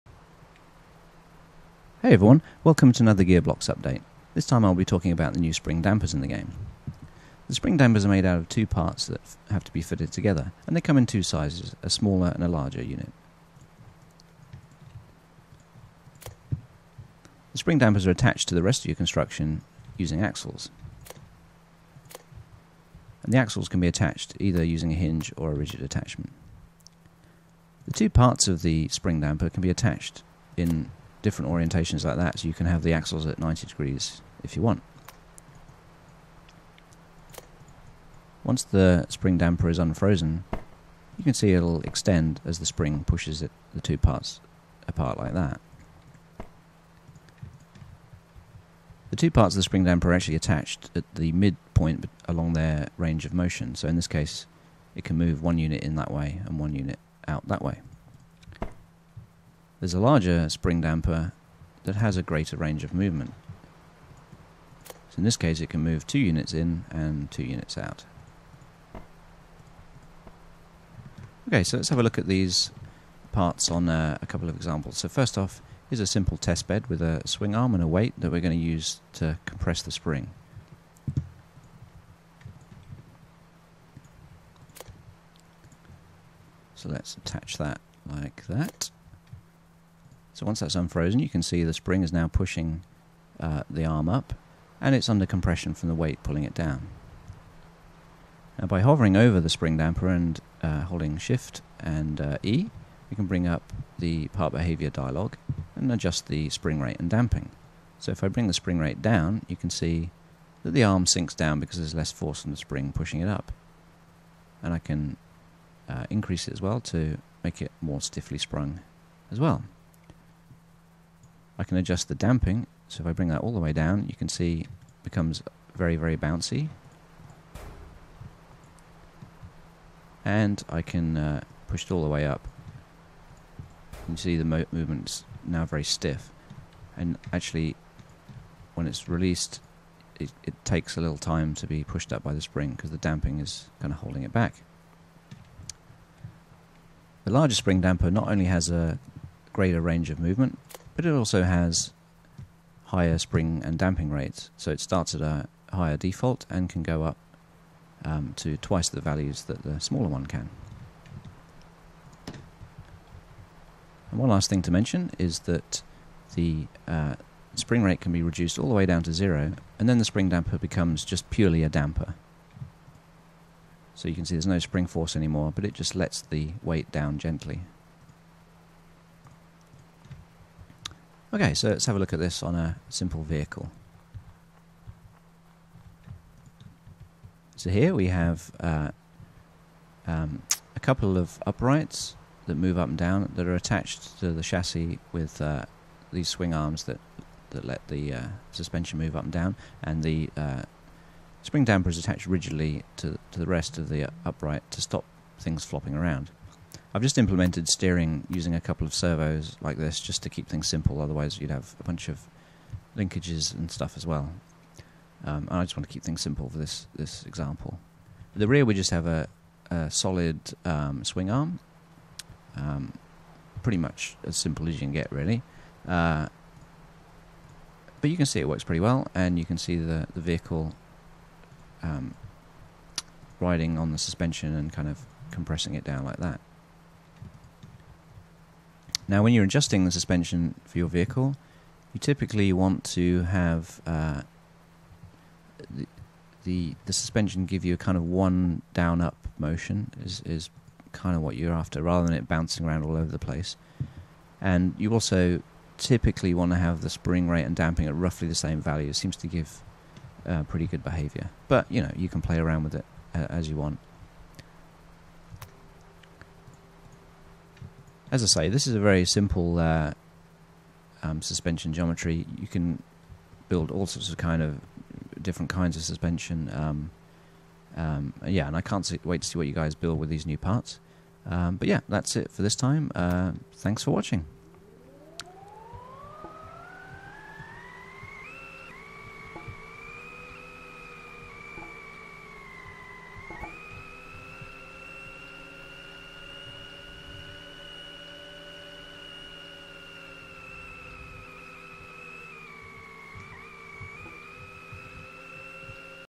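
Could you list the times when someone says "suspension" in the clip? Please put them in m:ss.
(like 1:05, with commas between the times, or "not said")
3:18, 3:53, 3:59, 4:06, 4:31, 4:35.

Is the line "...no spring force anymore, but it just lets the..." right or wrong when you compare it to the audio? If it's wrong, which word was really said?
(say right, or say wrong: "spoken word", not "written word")
right.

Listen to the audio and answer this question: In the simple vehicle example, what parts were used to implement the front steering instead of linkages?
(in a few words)
Servos.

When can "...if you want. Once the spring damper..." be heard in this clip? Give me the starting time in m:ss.
0:34.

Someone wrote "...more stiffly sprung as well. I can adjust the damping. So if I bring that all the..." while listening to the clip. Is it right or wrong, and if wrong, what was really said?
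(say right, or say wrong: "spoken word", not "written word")
right.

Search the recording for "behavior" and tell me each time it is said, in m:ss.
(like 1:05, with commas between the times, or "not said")
1:44, 4:20.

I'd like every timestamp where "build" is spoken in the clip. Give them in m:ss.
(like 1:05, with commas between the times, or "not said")
4:33, 4:39.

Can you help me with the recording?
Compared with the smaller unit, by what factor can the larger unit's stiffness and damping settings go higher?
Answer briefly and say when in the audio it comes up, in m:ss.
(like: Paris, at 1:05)
Twice, at 2:38.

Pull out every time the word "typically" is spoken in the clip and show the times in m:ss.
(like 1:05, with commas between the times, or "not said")
4:01, 4:15.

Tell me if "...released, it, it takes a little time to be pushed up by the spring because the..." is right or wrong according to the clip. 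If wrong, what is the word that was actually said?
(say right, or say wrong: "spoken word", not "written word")
right.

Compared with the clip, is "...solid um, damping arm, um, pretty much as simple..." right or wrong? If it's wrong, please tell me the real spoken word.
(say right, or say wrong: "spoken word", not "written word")
wrong: "swing", not "damping".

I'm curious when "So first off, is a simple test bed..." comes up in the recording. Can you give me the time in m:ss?
1:14.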